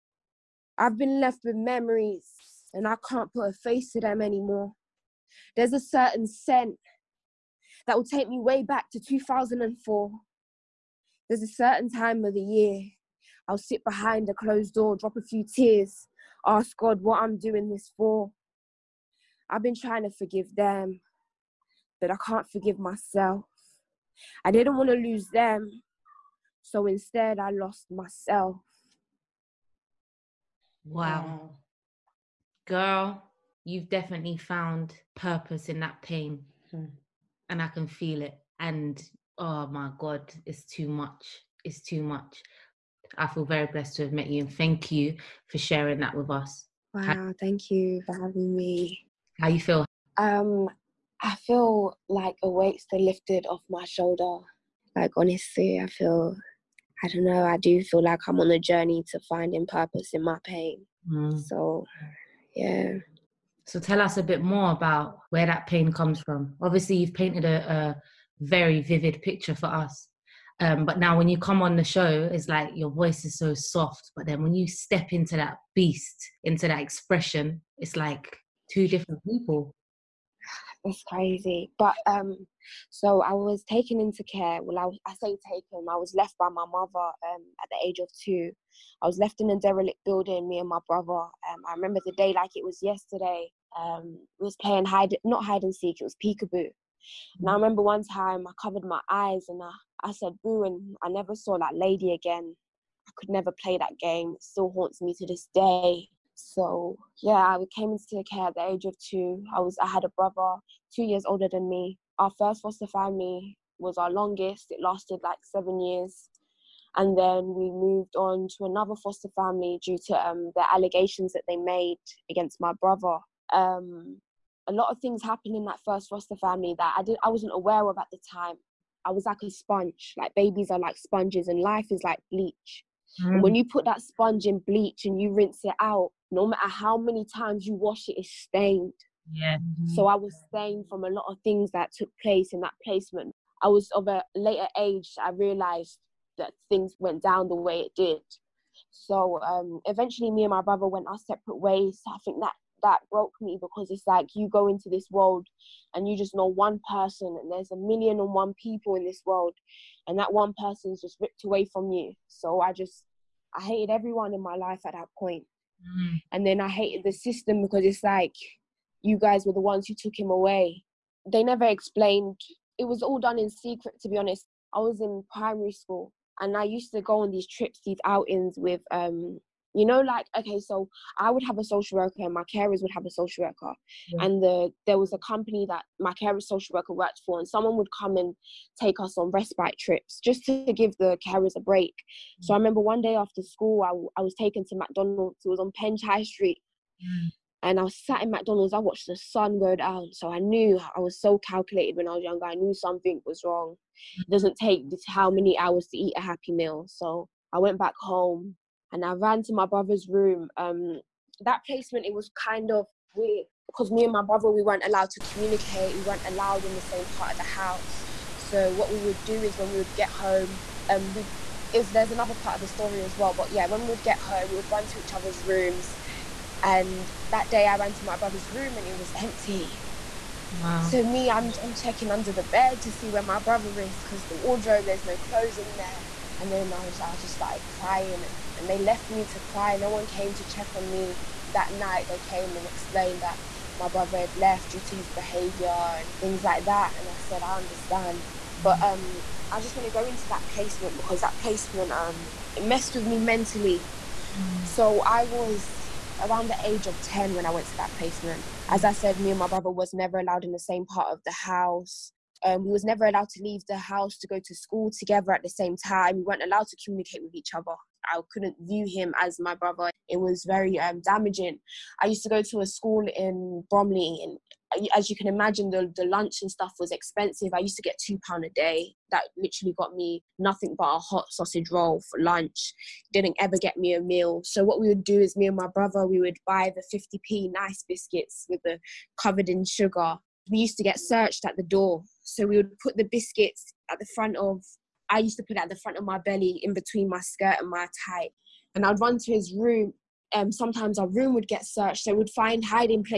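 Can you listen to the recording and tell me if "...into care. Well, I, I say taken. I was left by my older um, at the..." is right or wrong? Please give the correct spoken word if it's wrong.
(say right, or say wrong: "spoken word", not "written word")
wrong: "mother", not "older".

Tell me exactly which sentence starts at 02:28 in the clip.
So um, eventually, me and my brother went our separate ways.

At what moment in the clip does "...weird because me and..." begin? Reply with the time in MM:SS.
03:33.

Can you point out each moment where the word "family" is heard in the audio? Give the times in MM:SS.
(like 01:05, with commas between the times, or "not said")
01:52, 01:59, 02:06.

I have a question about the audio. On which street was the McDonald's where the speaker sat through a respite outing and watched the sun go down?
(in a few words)
Pench Street.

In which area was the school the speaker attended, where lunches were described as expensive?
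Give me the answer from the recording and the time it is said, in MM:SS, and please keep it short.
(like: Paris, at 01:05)
Bromley, at 04:33.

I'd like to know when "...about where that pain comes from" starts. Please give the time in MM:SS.
01:04.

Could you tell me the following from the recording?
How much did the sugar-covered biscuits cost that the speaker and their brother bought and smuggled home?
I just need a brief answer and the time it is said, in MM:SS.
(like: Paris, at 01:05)
50p, at 04:47.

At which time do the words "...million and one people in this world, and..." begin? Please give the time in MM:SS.
02:37.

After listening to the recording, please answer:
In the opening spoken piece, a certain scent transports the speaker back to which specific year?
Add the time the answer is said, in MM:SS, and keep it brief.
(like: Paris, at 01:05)
2004, at 00:09.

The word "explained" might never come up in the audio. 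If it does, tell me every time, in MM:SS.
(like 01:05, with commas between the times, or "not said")
02:51, 04:02.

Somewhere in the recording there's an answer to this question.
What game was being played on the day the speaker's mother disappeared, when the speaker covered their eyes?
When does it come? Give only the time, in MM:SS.
01:36.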